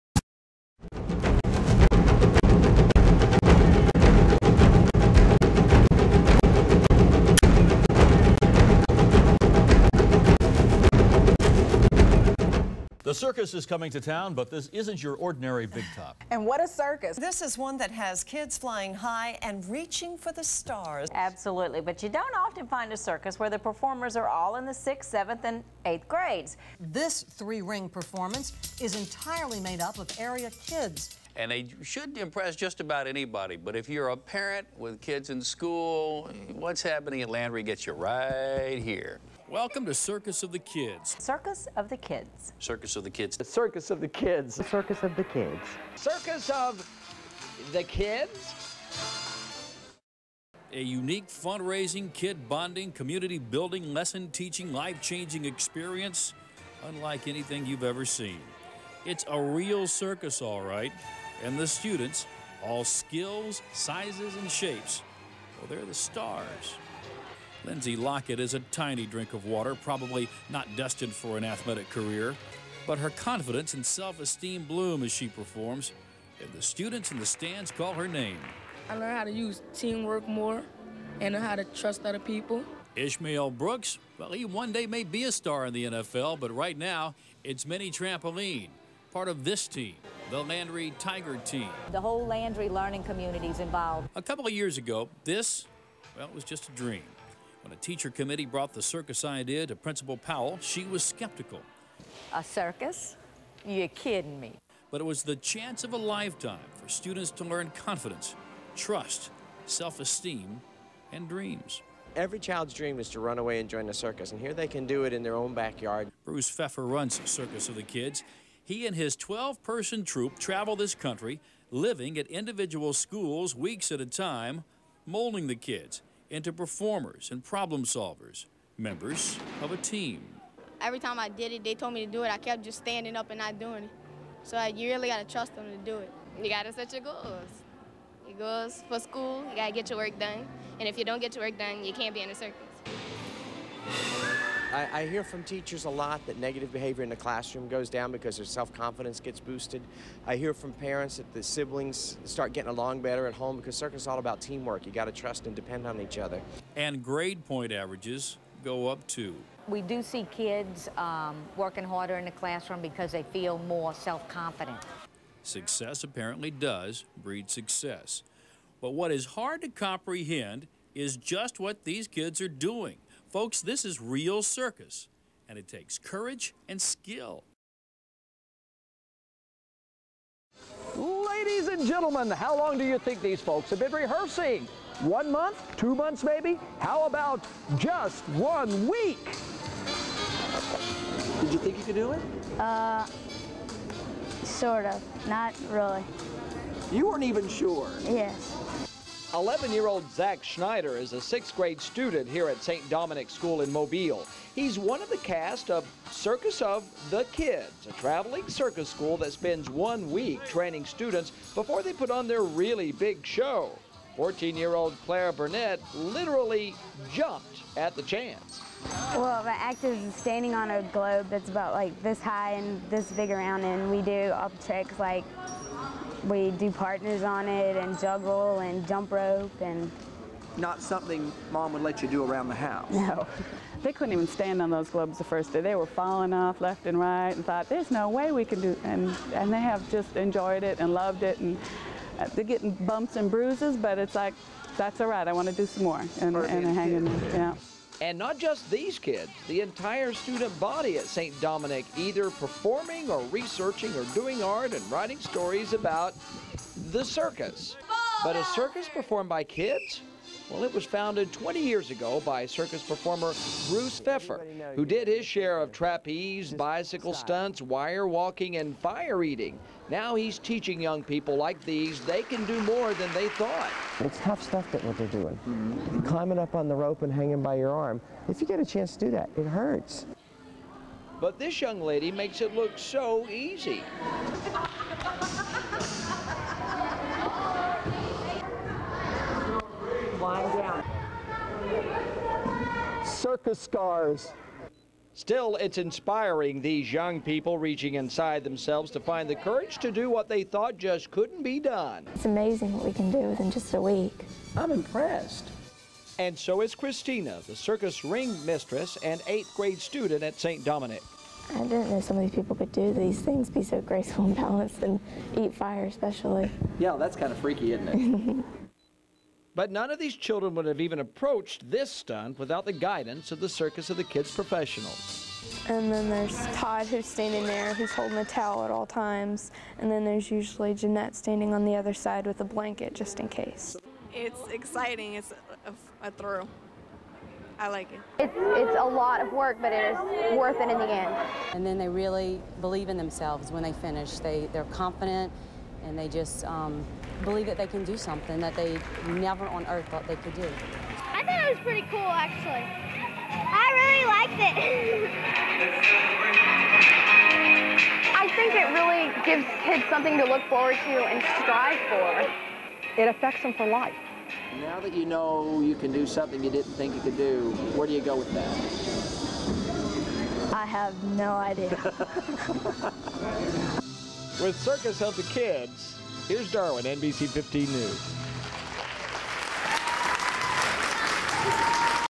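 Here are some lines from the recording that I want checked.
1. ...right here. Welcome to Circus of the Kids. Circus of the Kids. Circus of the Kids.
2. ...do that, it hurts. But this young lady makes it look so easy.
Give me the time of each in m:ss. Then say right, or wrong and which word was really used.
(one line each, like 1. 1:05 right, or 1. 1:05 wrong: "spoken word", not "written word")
1. 0:37 right
2. 4:39 right.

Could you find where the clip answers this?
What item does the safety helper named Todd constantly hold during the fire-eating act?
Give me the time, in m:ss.
5:28.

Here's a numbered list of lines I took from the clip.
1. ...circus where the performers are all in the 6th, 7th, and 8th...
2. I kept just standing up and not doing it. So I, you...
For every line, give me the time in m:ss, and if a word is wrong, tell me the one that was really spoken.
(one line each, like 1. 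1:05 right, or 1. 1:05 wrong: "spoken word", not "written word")
1. 0:23 right
2. 2:12 right.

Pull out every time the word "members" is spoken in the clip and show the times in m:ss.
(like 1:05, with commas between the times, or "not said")
2:08.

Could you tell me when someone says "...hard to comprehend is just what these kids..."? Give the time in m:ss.
2:49.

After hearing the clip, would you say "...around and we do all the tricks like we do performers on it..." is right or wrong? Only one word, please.
wrong.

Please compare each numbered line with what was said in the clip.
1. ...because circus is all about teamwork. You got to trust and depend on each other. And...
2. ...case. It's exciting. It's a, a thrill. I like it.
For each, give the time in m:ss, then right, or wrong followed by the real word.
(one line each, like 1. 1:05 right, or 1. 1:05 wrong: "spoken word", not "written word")
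1. 2:33 right
2. 5:33 right.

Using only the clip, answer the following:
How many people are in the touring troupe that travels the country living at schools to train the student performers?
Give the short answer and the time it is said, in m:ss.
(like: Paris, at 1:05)
12, at 1:59.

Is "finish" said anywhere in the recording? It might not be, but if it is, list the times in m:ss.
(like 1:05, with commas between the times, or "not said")
5:43.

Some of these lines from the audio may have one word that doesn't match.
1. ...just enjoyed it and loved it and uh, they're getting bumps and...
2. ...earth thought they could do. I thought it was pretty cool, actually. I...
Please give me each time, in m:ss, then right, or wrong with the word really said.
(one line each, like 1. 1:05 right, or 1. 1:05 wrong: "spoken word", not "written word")
1. 3:59 right
2. 5:49 right.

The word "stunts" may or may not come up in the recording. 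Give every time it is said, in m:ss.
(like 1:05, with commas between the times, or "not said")
4:27, 5:21.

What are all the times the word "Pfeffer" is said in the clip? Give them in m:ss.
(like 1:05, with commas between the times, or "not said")
1:56, 4:24.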